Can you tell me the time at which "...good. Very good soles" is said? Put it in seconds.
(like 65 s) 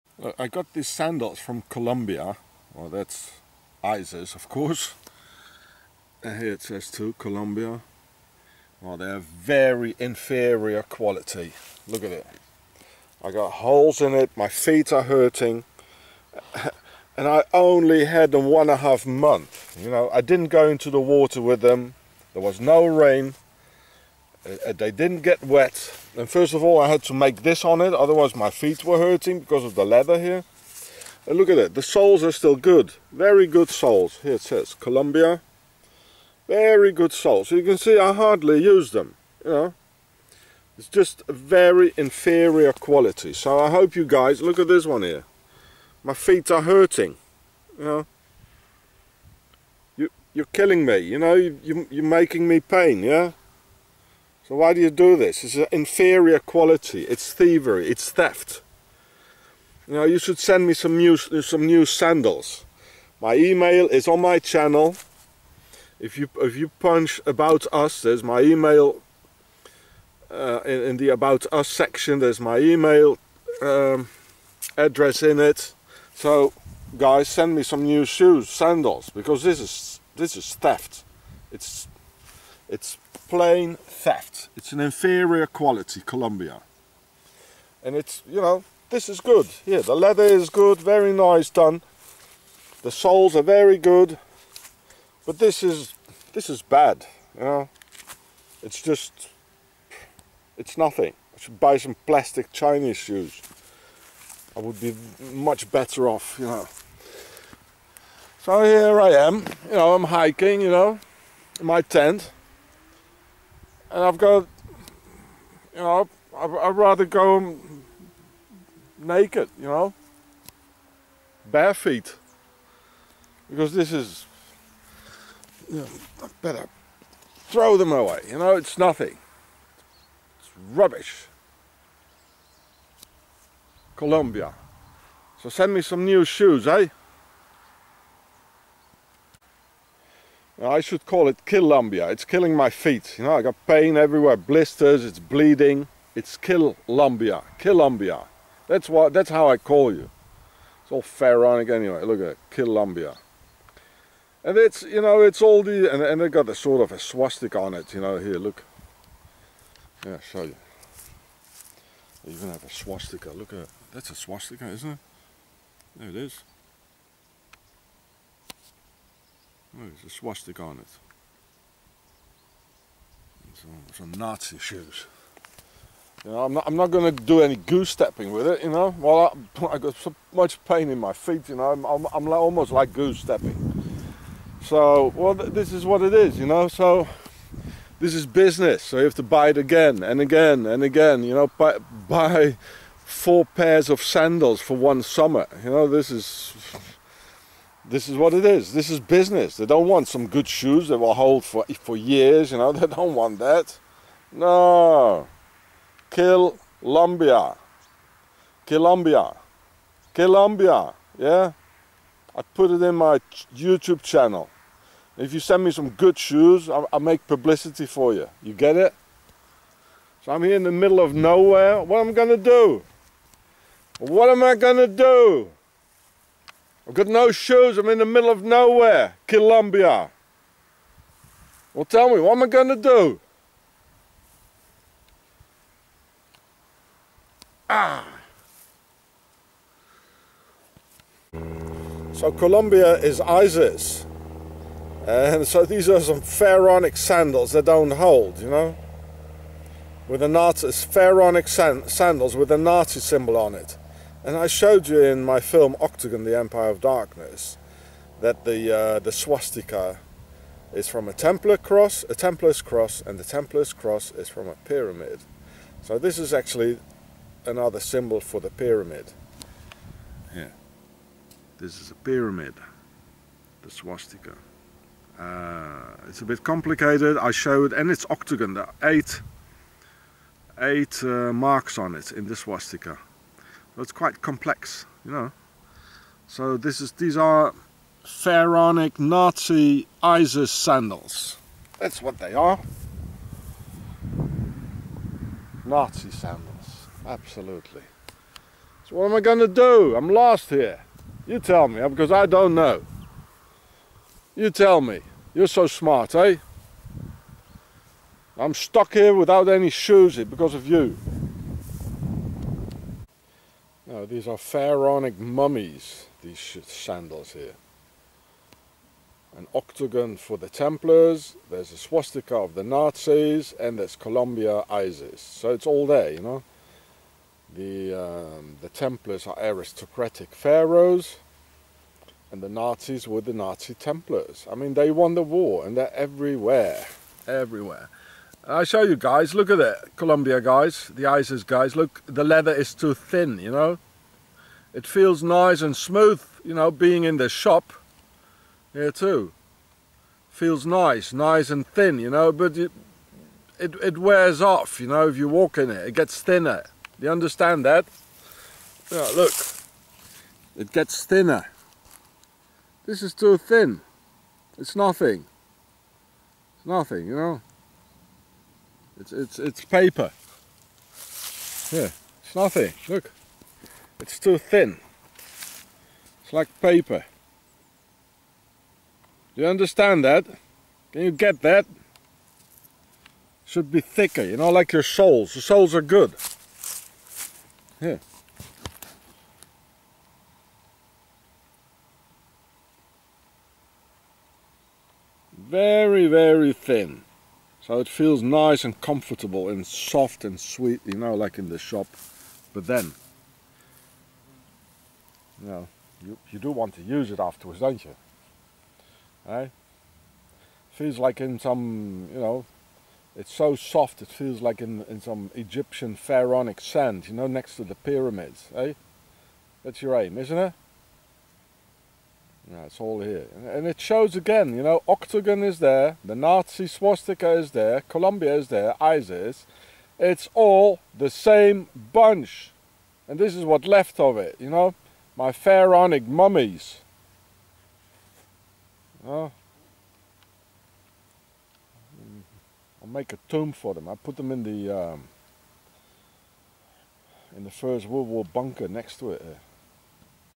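32 s.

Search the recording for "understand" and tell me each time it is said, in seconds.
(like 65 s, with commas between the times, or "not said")
357 s, 379 s.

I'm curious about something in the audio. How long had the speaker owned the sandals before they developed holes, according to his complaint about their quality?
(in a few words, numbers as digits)
1.5 months.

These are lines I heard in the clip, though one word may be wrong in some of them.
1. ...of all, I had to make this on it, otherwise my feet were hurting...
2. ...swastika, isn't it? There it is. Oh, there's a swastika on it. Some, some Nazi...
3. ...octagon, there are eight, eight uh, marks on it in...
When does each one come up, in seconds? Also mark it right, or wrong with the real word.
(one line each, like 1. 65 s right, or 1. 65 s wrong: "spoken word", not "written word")
1. 26 s right
2. 164 s right
3. 278 s right.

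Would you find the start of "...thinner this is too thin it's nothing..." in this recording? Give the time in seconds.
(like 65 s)
361 s.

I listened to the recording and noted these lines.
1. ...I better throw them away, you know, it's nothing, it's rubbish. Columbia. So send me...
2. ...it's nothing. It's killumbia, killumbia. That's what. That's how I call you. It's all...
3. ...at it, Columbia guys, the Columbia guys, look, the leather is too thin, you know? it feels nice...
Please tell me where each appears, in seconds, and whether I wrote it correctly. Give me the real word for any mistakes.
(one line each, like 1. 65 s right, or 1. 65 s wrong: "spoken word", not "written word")
1. 126 s right
2. 145 s wrong: "bleeding", not "nothing"
3. 339 s wrong: "ISIS", not "Columbia".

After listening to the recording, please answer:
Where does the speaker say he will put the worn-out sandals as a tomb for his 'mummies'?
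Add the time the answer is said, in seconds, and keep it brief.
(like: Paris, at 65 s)
First World War bunker, at 447 s.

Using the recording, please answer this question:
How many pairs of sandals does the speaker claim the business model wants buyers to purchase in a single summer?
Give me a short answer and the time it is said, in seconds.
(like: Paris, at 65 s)
4, at 193 s.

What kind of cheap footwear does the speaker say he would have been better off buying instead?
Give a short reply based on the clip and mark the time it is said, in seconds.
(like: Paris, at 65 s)
plastic Chinese shoes, at 102 s.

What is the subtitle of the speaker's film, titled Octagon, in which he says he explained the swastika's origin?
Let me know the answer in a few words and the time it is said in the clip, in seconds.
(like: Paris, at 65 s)
The Empire of Darkness, at 256 s.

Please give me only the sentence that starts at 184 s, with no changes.
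So, well, th this is what it is, you know.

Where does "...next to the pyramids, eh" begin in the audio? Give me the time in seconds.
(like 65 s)
417 s.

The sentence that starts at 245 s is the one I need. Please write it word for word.
And so these are some pharaonic sandals that don't hold, you know?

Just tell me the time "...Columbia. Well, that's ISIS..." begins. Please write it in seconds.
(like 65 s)
1 s.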